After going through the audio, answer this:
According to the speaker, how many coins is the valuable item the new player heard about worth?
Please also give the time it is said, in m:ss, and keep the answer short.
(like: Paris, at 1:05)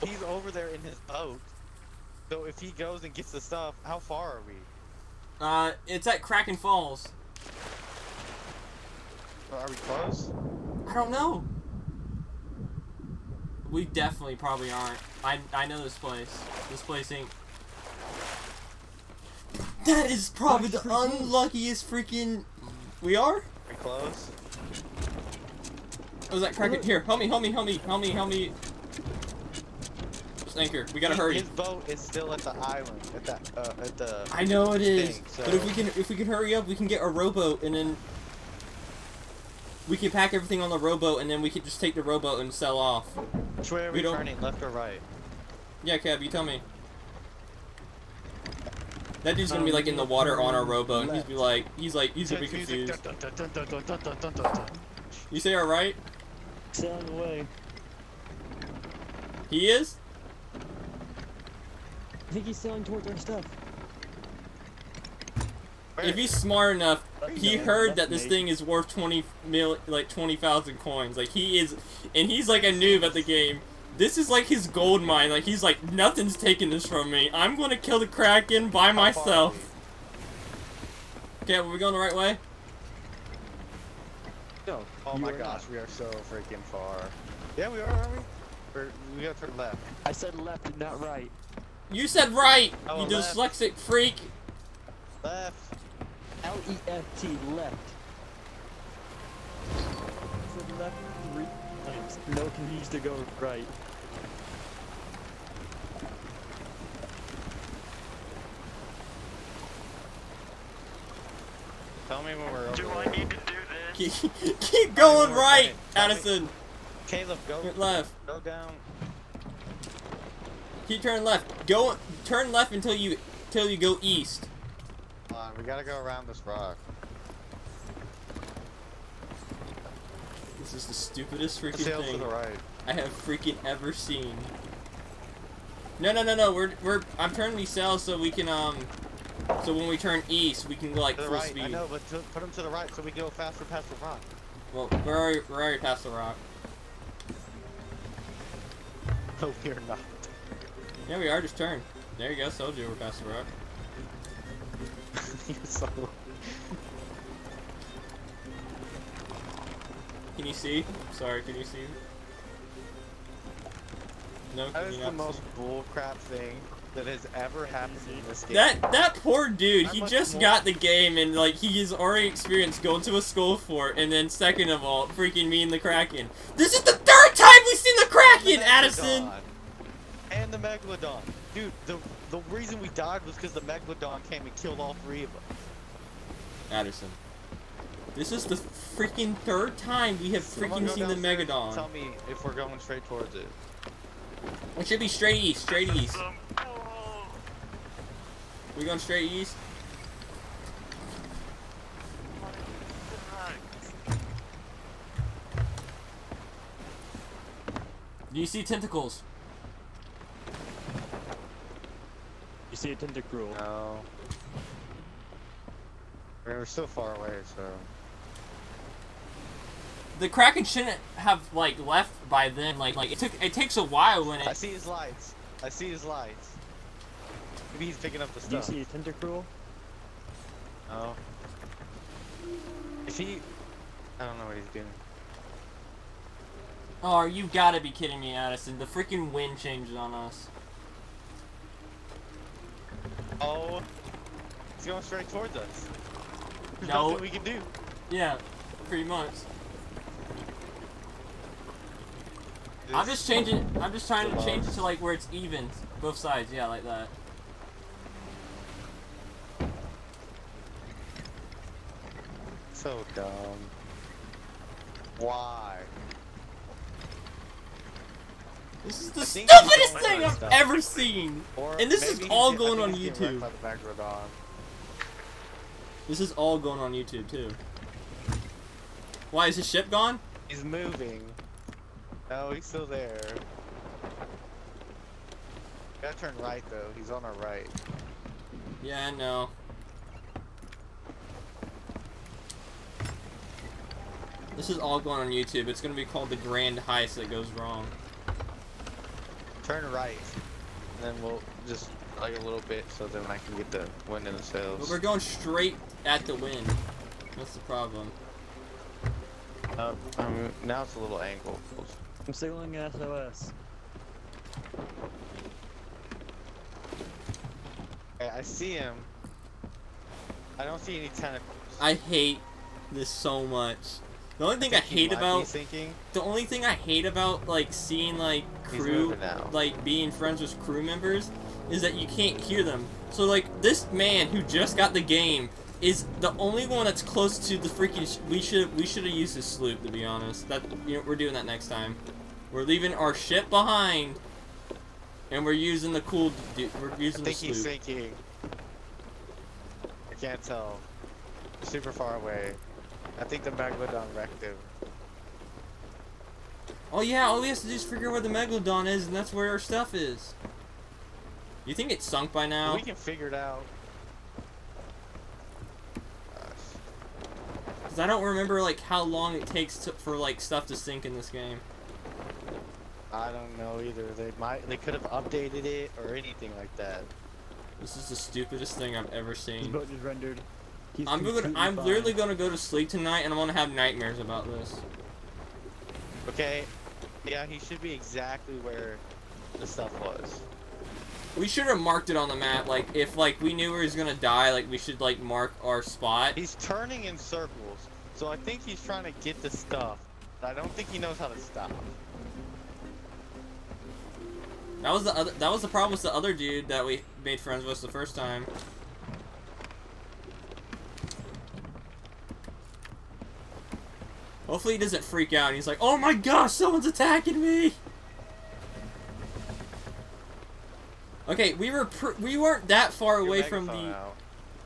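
20,000 coins, at 1:10.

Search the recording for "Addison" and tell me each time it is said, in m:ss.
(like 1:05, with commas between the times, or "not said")
1:55, 2:58, 3:06, 3:58.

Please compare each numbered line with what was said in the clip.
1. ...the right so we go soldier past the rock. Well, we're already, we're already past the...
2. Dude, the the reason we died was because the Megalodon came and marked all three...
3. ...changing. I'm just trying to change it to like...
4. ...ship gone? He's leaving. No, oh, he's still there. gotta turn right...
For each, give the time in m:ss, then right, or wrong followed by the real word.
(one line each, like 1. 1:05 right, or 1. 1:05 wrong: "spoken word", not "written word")
1. 2:22 wrong: "faster", not "soldier"
2. 3:01 wrong: "killed", not "marked"
3. 4:13 right
4. 4:39 wrong: "moving", not "leaving".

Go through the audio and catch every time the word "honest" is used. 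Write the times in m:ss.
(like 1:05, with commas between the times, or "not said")
5:40.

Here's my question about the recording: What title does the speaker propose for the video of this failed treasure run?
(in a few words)
The grand heist that goes wrong.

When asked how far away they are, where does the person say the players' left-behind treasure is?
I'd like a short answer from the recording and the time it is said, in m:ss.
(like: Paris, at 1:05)
Kraken Falls, at 0:06.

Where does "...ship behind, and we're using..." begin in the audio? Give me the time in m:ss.
5:43.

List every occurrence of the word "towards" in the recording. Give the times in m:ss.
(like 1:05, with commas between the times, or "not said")
1:02, 3:13, 4:05.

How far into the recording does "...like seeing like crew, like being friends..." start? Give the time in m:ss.
5:27.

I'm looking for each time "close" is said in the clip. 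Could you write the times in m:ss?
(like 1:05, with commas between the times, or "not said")
0:09, 0:23, 5:37.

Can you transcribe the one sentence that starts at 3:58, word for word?
The freaking wind changes on us.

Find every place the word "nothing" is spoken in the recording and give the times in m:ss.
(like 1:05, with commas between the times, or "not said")
1:15, 4:07.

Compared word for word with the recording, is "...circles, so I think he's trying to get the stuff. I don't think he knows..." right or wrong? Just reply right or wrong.
right.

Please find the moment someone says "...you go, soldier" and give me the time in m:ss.
2:32.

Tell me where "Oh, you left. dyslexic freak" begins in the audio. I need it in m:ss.
1:32.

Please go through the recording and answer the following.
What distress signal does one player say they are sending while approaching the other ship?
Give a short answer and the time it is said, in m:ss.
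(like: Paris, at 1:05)
SOS, at 5:12.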